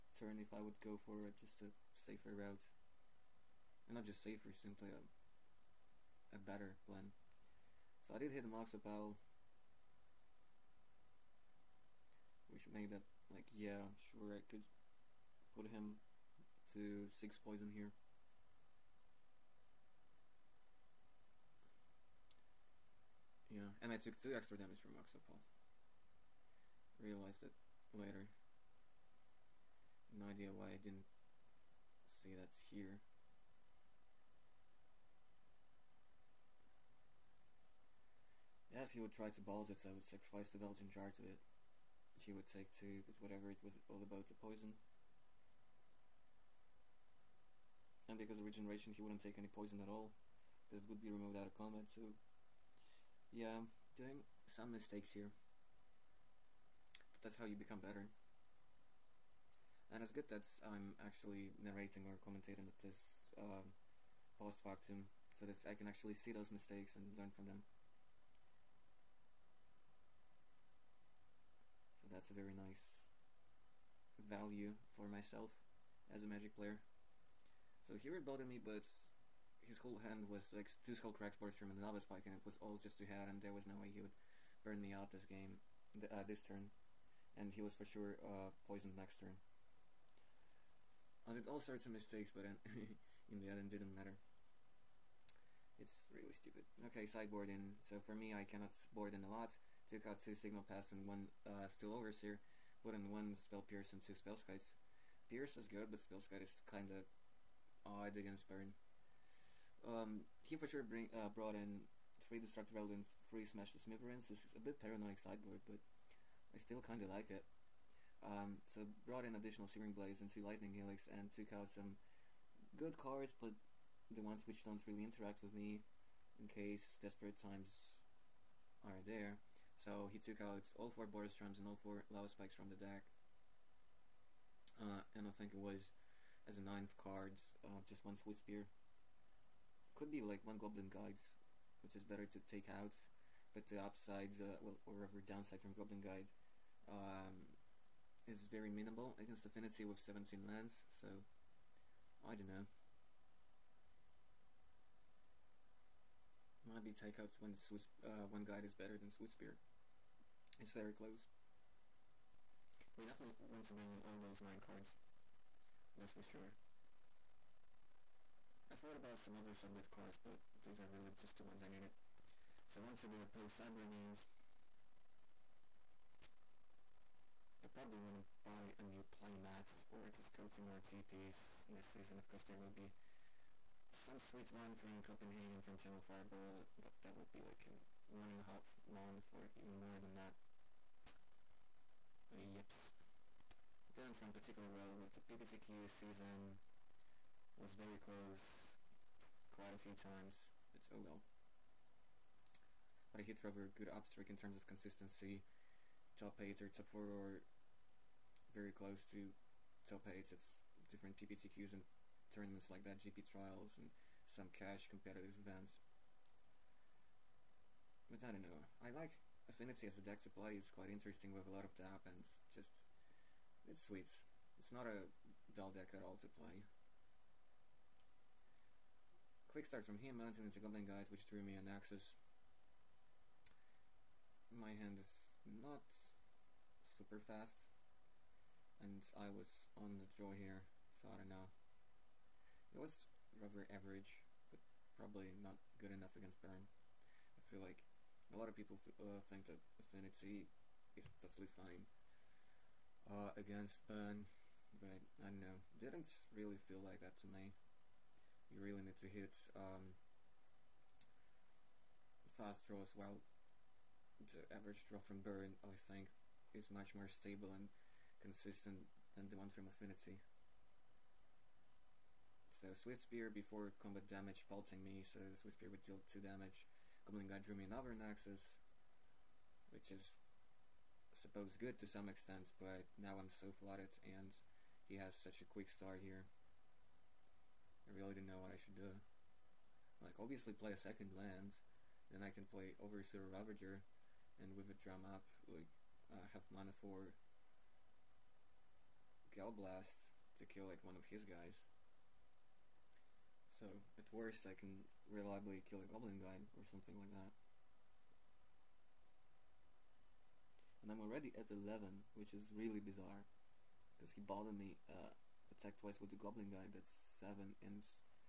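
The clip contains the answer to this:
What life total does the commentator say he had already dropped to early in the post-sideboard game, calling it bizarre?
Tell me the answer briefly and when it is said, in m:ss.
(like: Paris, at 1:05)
11, at 5:11.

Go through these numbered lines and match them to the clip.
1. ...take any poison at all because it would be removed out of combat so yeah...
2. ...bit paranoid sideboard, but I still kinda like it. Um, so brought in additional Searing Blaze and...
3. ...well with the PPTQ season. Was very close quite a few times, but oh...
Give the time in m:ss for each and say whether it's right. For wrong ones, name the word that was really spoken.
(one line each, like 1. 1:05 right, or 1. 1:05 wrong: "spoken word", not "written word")
1. 0:49 right
2. 1:54 right
3. 3:14 right.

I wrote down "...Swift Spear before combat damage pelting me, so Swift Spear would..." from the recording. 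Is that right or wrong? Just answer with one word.
right.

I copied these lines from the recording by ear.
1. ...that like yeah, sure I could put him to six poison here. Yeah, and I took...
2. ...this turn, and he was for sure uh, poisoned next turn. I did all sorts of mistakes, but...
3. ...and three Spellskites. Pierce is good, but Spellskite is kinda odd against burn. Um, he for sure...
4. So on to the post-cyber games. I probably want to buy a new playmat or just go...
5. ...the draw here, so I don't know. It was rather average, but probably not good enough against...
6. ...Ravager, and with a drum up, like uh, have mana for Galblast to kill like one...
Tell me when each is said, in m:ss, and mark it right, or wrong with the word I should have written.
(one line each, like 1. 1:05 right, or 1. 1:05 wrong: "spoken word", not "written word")
1. 0:12 right
2. 1:26 right
3. 1:43 wrong: "two", not "three"
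4. 2:52 right
5. 3:59 right
6. 4:53 right.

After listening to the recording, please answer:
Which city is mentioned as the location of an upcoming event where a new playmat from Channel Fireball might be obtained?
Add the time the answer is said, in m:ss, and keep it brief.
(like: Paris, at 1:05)
Copenhagen, at 3:05.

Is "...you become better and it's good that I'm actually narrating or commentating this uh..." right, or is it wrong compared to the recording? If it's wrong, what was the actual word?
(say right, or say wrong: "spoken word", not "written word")
right.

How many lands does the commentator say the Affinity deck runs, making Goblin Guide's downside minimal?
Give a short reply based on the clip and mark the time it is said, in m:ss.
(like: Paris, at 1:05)
17, at 2:30.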